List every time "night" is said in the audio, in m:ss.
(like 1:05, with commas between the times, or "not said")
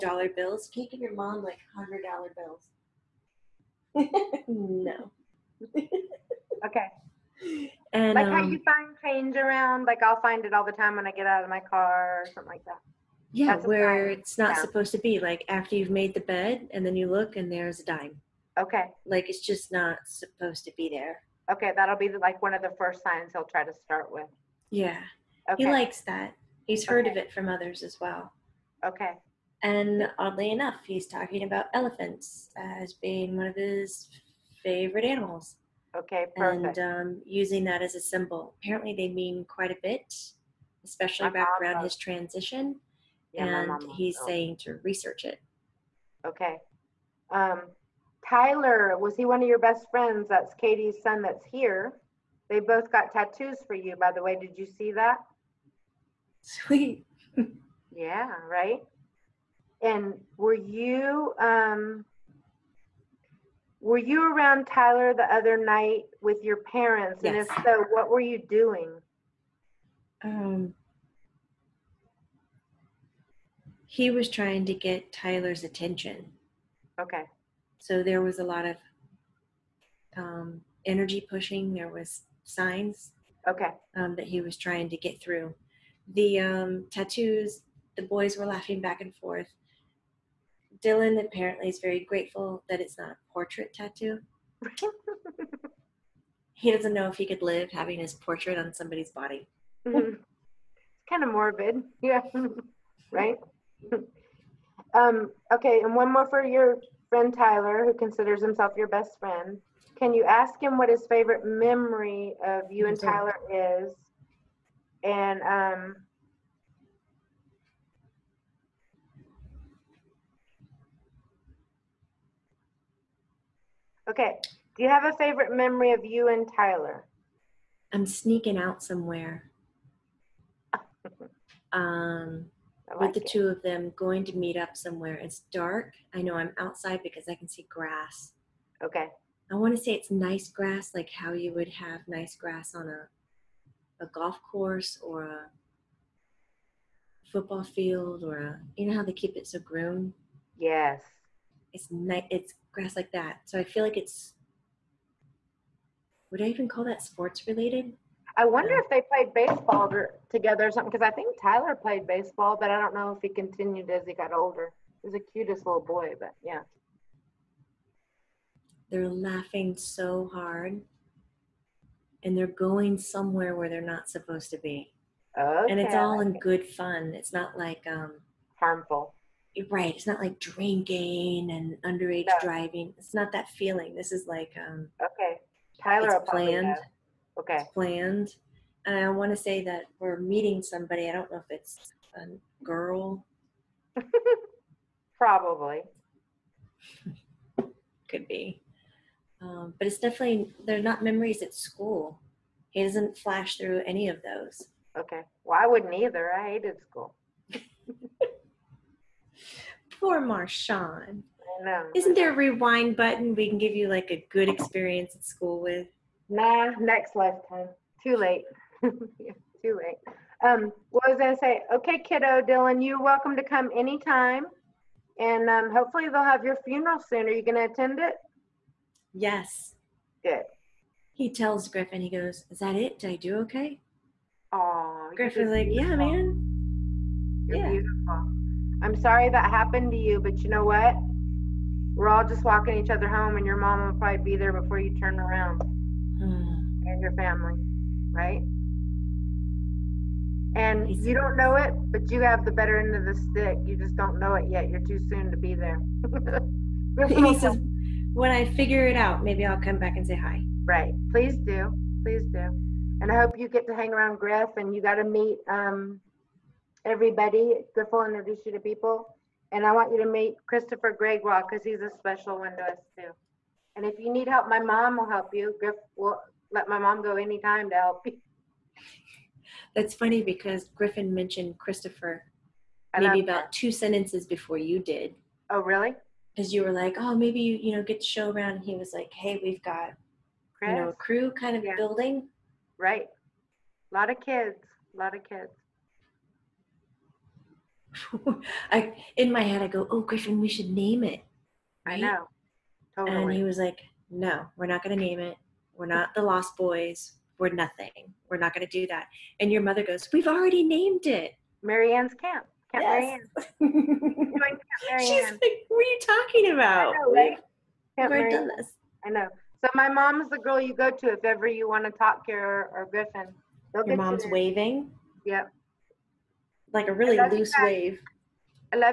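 1:05, 2:31.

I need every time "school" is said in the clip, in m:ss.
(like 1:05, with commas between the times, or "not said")
3:21, 3:26, 3:35.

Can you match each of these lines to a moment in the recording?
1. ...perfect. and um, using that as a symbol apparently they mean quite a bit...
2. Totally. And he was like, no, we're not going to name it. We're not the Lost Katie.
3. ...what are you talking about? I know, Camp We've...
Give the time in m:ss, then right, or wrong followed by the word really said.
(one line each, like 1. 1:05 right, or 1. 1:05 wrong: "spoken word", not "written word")
1. 0:36 right
2. 5:02 wrong: "Boys", not "Katie"
3. 5:15 right.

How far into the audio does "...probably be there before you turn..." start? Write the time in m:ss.
4:03.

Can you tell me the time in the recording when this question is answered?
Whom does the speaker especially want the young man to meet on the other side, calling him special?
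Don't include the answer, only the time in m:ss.
4:30.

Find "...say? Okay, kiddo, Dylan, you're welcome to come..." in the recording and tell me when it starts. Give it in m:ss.
3:41.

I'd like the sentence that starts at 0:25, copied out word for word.
he likes that he's heard okay.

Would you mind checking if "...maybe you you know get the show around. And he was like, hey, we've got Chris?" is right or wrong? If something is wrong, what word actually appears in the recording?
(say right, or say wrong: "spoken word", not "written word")
right.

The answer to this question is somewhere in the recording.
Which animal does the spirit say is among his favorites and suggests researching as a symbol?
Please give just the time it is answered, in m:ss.
0:31.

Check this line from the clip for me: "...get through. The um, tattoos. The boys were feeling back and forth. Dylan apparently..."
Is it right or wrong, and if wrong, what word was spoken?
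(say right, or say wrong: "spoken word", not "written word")
wrong: "laughing", not "feeling".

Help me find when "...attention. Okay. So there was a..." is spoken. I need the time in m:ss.
1:15.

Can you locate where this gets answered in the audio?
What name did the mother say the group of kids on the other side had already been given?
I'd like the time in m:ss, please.
5:11.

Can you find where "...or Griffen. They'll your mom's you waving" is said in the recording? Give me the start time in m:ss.
5:22.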